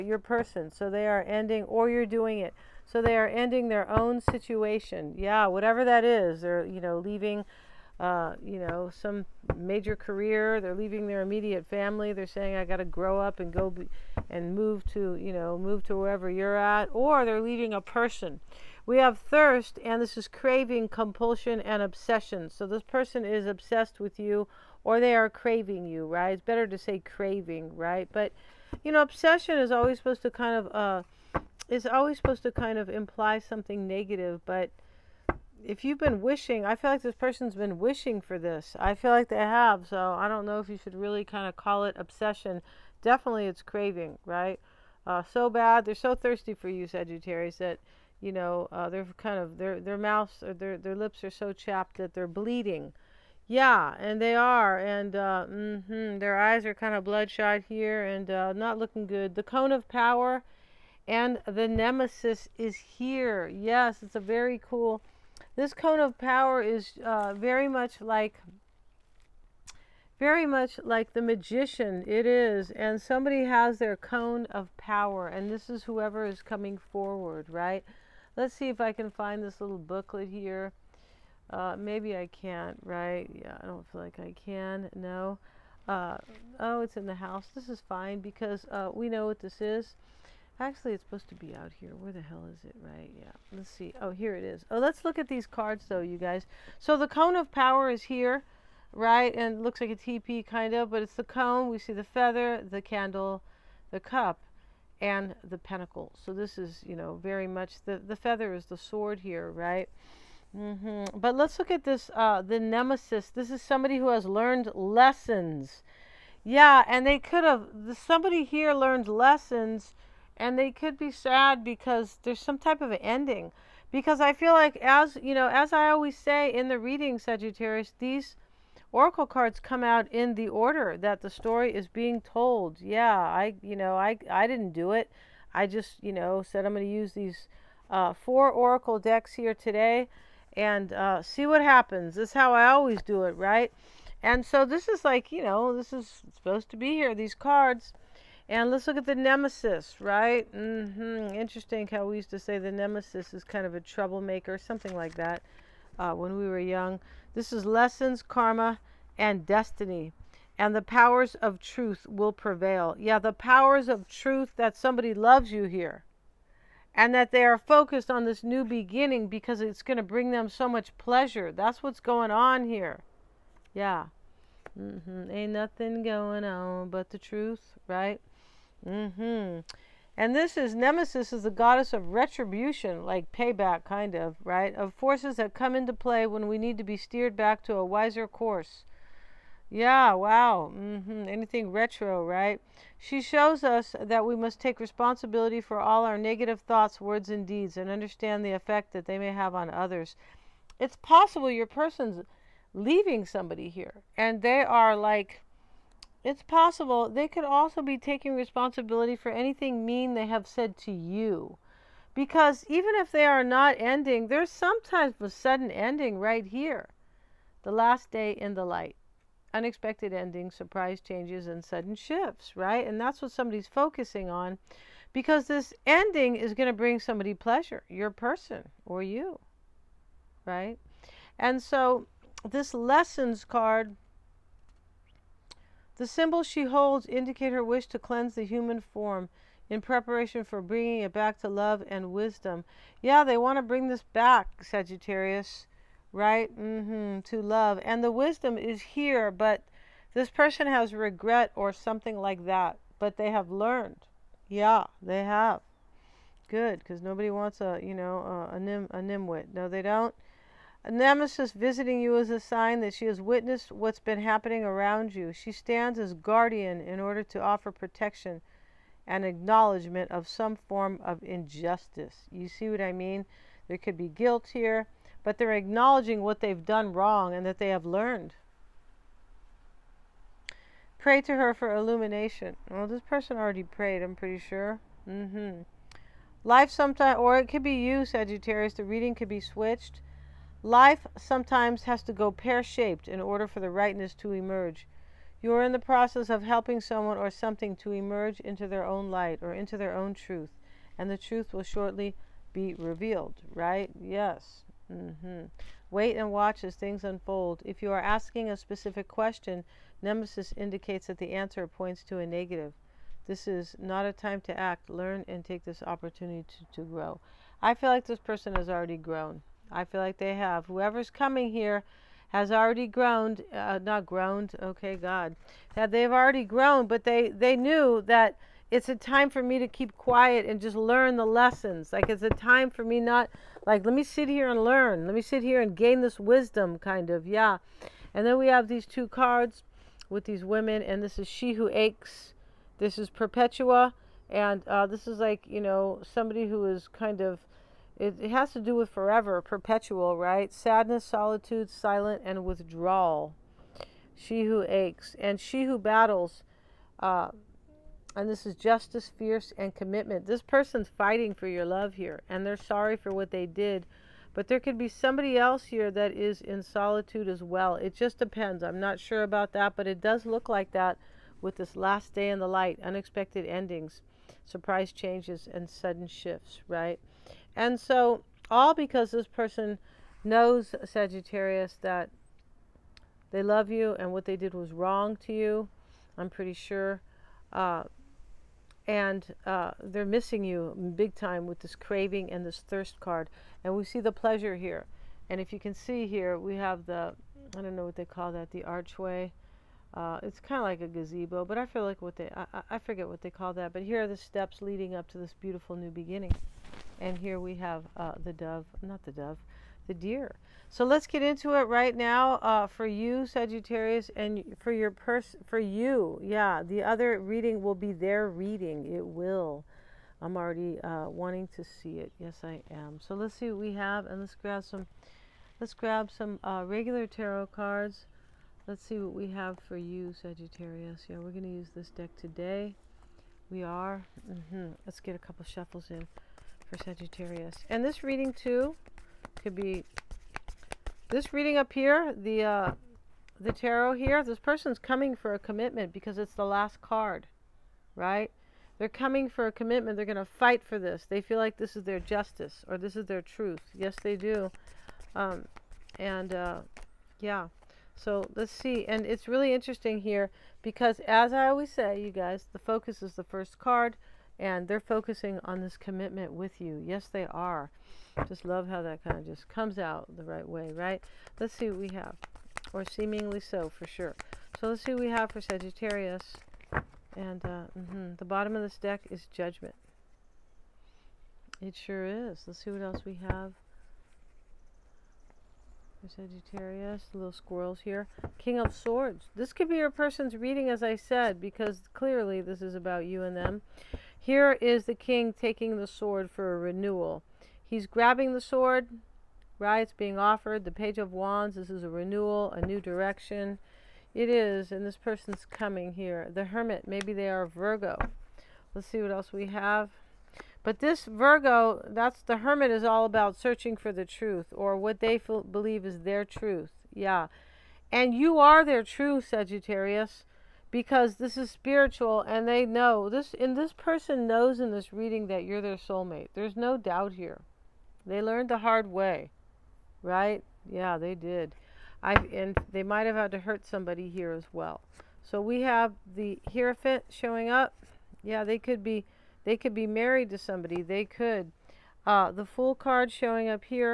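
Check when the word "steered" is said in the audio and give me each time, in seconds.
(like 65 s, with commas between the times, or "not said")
186 s.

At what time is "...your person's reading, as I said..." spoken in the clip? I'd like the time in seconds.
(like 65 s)
489 s.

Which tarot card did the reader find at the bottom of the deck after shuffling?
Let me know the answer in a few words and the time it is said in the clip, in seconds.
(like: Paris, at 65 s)
Judgment, at 479 s.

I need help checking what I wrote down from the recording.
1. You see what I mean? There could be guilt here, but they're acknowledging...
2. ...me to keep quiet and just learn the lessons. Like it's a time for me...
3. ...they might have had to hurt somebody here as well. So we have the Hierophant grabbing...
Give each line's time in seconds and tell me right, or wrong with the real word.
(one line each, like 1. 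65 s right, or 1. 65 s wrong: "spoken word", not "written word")
1. 272 s right
2. 329 s right
3. 532 s wrong: "showing", not "grabbing".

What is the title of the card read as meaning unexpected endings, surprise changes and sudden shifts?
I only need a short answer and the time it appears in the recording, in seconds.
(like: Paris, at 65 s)
The last day in the light, at 217 s.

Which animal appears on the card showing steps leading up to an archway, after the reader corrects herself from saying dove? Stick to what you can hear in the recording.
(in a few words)
Deer.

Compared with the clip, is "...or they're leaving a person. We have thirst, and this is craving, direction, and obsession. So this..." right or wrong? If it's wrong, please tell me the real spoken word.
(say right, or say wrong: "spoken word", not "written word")
wrong: "compulsion", not "direction".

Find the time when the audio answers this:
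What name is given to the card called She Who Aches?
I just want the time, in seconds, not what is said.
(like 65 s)
343 s.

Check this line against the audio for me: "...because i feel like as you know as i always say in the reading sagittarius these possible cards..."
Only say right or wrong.
wrong.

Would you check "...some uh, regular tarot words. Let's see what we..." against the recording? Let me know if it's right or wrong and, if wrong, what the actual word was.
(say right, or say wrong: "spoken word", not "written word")
wrong: "cards", not "words".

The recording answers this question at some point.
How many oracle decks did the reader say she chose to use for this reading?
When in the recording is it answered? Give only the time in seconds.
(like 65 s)
138 s.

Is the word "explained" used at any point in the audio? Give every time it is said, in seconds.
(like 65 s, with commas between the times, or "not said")
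not said.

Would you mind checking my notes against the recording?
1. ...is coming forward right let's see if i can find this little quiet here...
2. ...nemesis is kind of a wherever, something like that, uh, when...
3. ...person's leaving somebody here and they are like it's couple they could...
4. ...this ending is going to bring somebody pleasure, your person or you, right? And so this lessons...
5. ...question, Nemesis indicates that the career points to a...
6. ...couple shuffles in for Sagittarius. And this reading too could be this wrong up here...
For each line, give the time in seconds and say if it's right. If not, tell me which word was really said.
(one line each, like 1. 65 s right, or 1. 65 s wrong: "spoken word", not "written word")
1. 76 s wrong: "booklet", not "quiet"
2. 152 s wrong: "troublemaker", not "wherever"
3. 201 s wrong: "possible", not "couple"
4. 225 s right
5. 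309 s wrong: "answer", not "career"
6. 435 s wrong: "reading", not "wrong".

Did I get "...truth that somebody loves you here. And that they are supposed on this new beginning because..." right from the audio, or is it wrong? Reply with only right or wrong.
wrong.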